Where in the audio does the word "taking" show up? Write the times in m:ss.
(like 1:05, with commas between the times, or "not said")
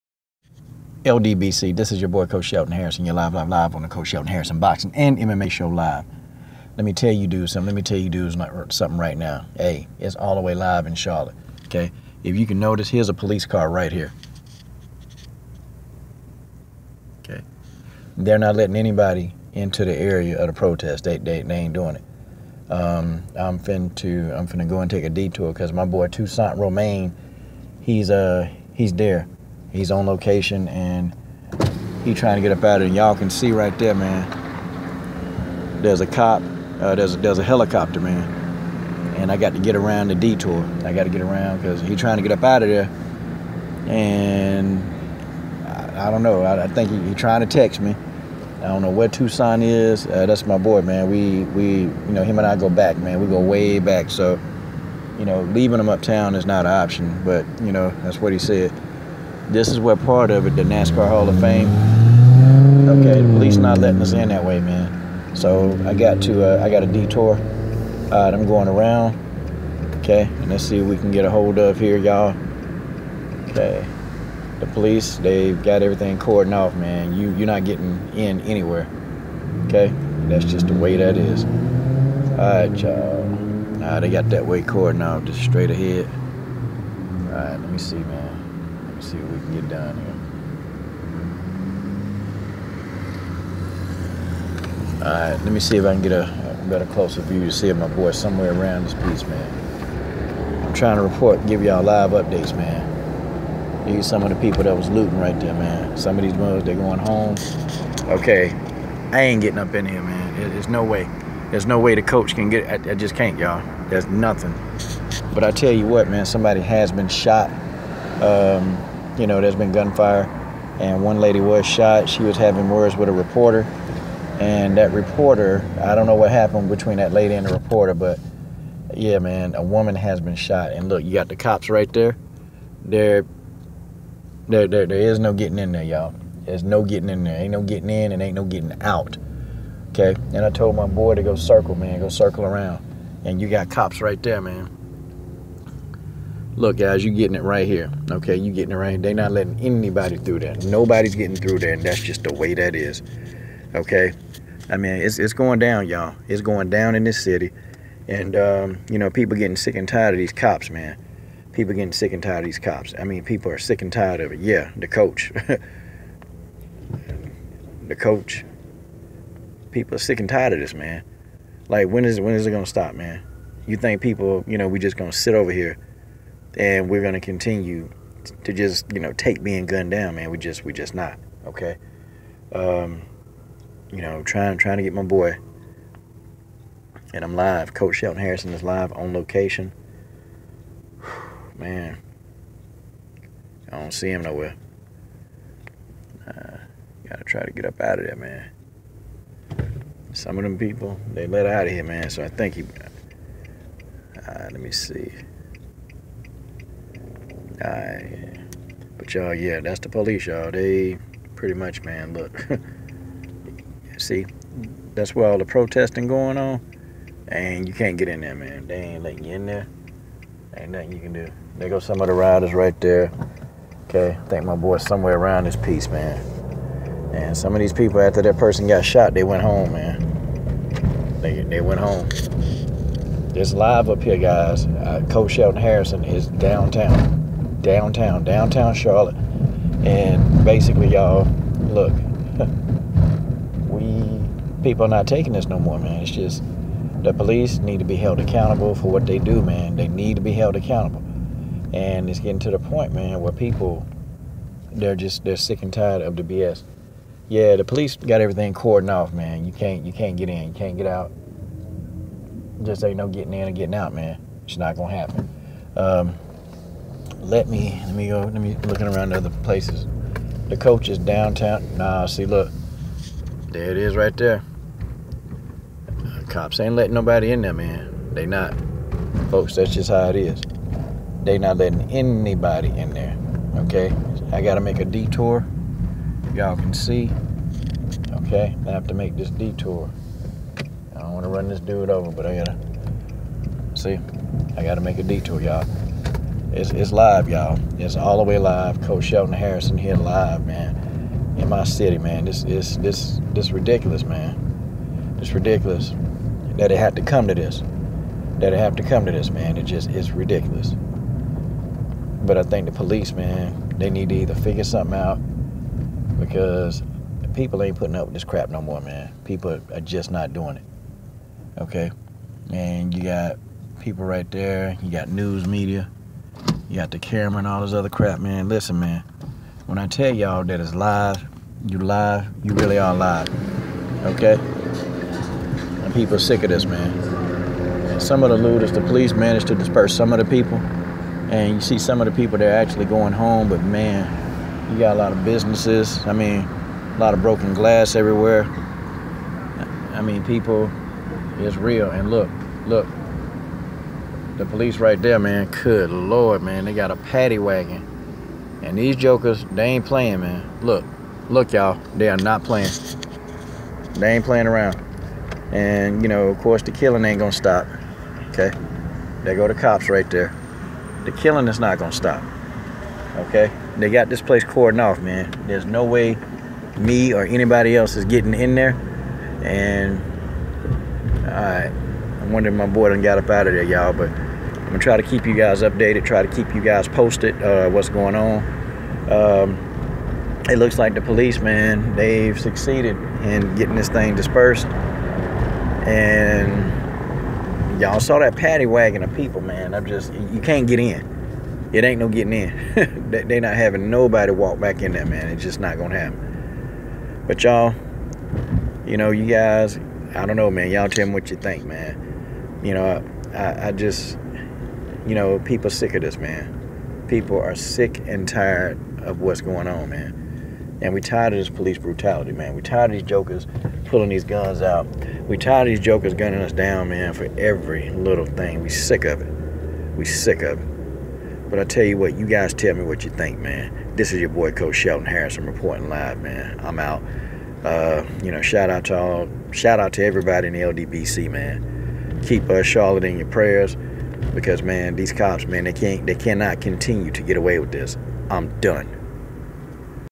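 4:05.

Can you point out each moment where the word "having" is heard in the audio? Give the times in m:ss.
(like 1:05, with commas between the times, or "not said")
2:02, 6:43.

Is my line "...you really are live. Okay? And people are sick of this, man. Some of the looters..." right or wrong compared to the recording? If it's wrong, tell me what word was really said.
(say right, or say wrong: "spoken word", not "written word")
right.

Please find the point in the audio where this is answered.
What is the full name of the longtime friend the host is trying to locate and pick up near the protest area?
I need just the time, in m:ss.
0:26.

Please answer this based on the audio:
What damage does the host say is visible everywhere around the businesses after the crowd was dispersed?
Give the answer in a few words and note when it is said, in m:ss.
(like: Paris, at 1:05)
broken glass, at 5:47.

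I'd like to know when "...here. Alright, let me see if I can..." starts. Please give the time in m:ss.
1:34.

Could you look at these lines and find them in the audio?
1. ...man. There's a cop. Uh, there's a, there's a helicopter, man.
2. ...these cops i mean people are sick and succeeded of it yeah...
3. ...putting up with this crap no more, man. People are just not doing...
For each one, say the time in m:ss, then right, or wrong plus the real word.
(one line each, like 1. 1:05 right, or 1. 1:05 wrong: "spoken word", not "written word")
1. 0:33 right
2. 2:42 wrong: "tired", not "succeeded"
3. 5:17 right.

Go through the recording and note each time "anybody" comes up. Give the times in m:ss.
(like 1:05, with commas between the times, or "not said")
0:18, 2:29, 4:41, 6:17.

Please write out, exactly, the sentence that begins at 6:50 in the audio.
Y'all tell me what you think, man.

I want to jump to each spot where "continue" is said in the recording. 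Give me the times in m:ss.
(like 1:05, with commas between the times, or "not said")
2:57, 7:26.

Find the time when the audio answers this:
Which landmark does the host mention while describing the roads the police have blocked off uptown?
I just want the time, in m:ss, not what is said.
1:00.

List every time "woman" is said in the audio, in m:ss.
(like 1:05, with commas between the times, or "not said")
2:09.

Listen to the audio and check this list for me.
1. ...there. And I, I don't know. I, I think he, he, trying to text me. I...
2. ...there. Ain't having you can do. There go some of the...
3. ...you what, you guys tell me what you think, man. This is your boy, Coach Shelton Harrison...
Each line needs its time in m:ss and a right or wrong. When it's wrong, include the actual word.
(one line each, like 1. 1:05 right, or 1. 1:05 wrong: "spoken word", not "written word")
1. 0:42 right
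2. 3:39 wrong: "nothing", not "having"
3. 7:11 right.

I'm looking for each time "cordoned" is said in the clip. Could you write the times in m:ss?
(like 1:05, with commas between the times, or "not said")
1:16, 1:24, 4:18, 6:14.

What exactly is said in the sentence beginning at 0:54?
So you know leaving him uptown is not an option.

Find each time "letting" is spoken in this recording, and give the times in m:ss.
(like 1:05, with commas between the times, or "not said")
0:18, 1:03, 2:29, 3:39, 4:36, 4:41.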